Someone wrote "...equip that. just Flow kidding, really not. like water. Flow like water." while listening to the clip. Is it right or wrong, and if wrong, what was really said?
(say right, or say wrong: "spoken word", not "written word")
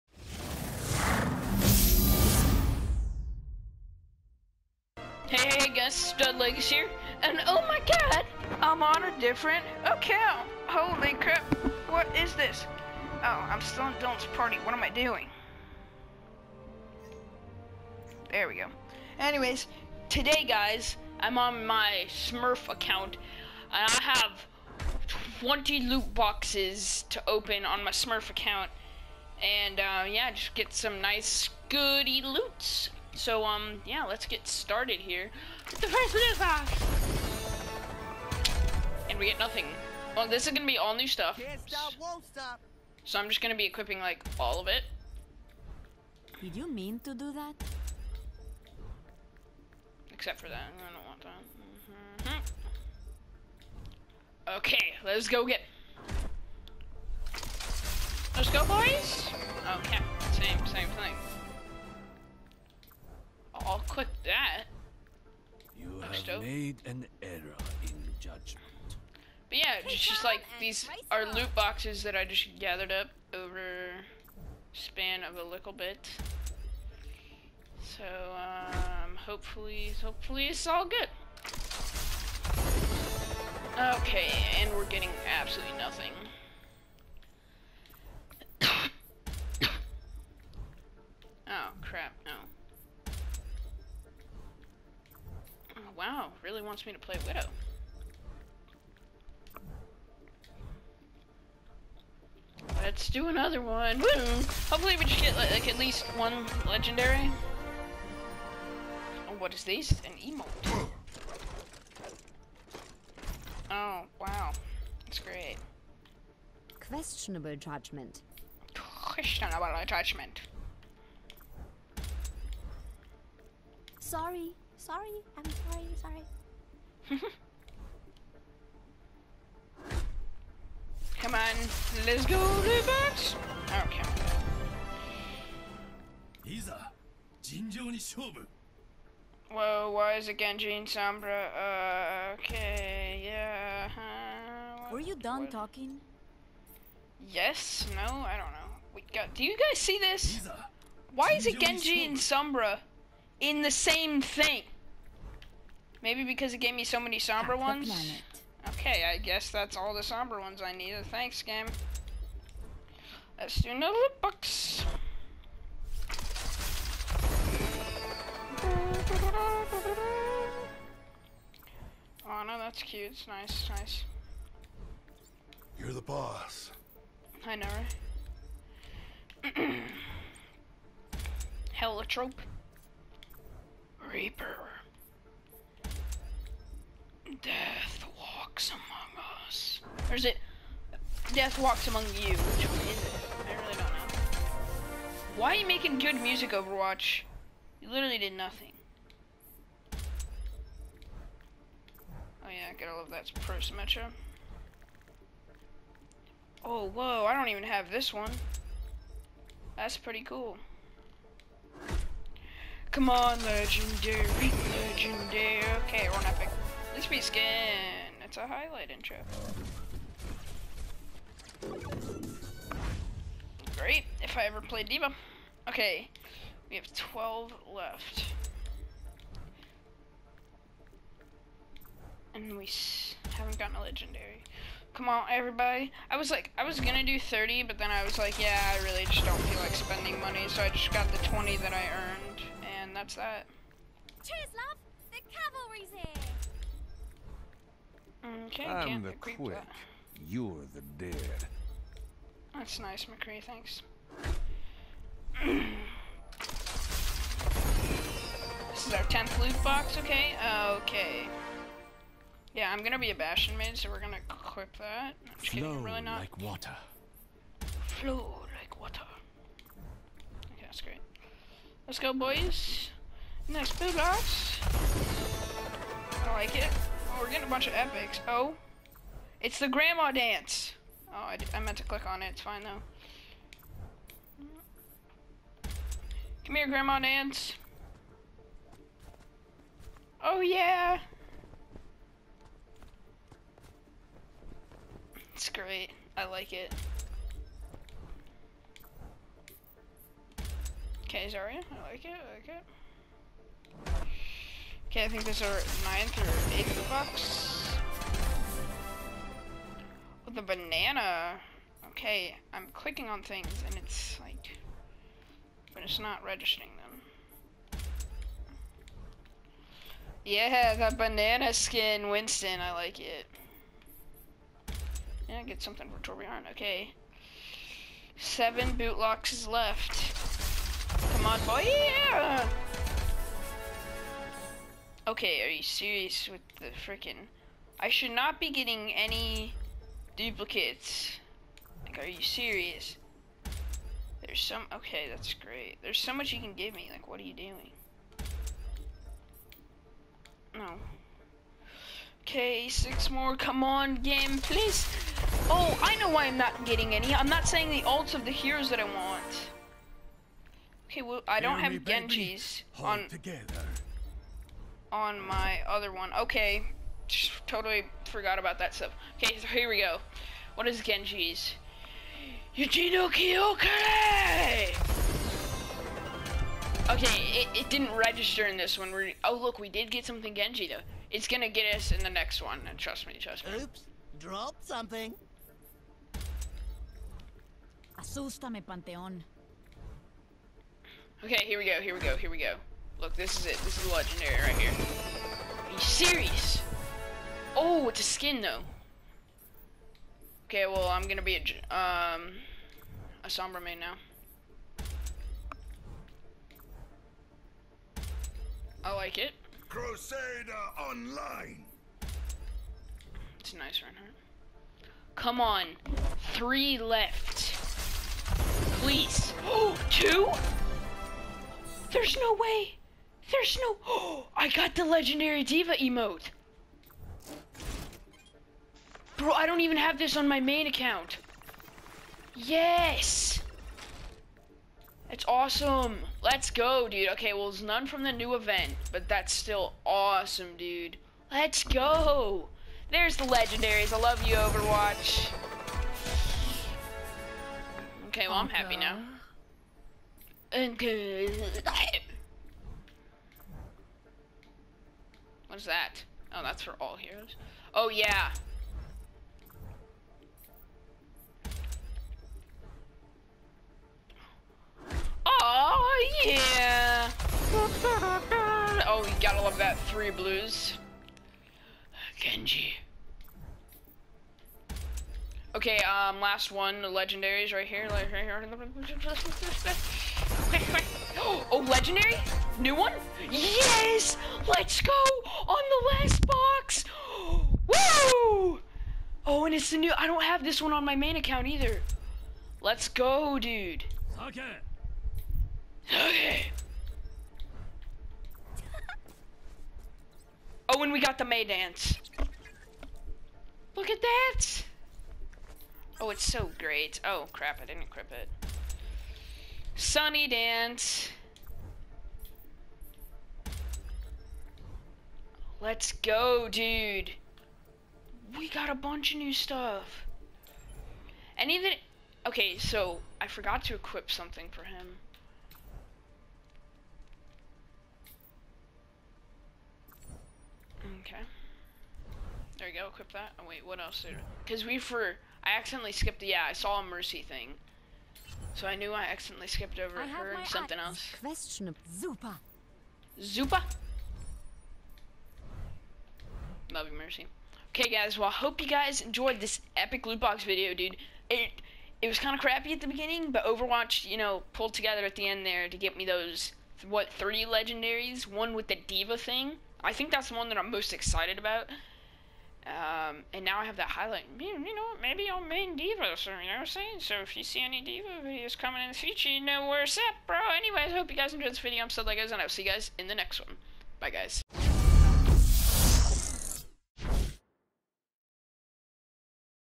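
right.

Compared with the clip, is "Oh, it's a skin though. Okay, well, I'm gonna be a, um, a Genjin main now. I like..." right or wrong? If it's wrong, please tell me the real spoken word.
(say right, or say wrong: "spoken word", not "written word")
wrong: "Sombra", not "Genjin".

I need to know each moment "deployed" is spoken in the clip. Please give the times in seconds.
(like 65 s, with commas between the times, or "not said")
not said.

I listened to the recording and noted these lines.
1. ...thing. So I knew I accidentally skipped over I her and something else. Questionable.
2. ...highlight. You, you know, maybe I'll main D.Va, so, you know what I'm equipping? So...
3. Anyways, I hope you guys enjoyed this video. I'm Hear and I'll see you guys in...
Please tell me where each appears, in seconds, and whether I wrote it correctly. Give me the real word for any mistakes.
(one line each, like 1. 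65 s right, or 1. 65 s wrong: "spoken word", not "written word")
1. 537 s right
2. 563 s wrong: "saying", not "equipping"
3. 570 s wrong: "Sub", not "Hear".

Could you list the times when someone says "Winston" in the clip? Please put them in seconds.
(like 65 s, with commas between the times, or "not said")
322 s.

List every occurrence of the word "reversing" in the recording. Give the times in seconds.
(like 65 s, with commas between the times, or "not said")
not said.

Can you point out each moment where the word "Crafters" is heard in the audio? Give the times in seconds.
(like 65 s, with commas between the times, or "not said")
not said.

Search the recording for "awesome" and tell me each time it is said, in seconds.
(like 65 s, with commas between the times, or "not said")
435 s, 439 s.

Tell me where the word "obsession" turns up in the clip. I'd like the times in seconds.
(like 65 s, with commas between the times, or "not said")
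not said.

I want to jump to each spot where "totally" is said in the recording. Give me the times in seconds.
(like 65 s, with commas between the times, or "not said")
367 s.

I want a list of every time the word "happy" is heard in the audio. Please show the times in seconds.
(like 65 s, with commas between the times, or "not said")
448 s.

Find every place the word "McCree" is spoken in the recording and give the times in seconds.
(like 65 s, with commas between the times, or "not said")
253 s.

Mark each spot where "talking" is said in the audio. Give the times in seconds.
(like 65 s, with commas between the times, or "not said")
145 s.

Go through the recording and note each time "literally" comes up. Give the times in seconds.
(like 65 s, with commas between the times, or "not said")
197 s.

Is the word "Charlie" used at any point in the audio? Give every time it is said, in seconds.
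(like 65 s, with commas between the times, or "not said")
not said.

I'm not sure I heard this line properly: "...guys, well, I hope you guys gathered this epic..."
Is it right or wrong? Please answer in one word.
wrong.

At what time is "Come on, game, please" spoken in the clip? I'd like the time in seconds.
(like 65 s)
353 s.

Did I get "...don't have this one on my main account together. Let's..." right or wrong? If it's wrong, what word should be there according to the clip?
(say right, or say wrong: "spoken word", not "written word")
wrong: "either", not "together".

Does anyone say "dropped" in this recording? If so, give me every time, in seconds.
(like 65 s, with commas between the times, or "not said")
384 s.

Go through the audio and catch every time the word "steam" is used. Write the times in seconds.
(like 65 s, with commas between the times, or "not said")
not said.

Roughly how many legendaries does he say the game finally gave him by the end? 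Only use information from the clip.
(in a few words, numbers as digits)
3.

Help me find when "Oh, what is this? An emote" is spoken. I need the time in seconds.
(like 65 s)
109 s.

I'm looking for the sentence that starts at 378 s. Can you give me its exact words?
We're, oh, look, we did get something Genji, though.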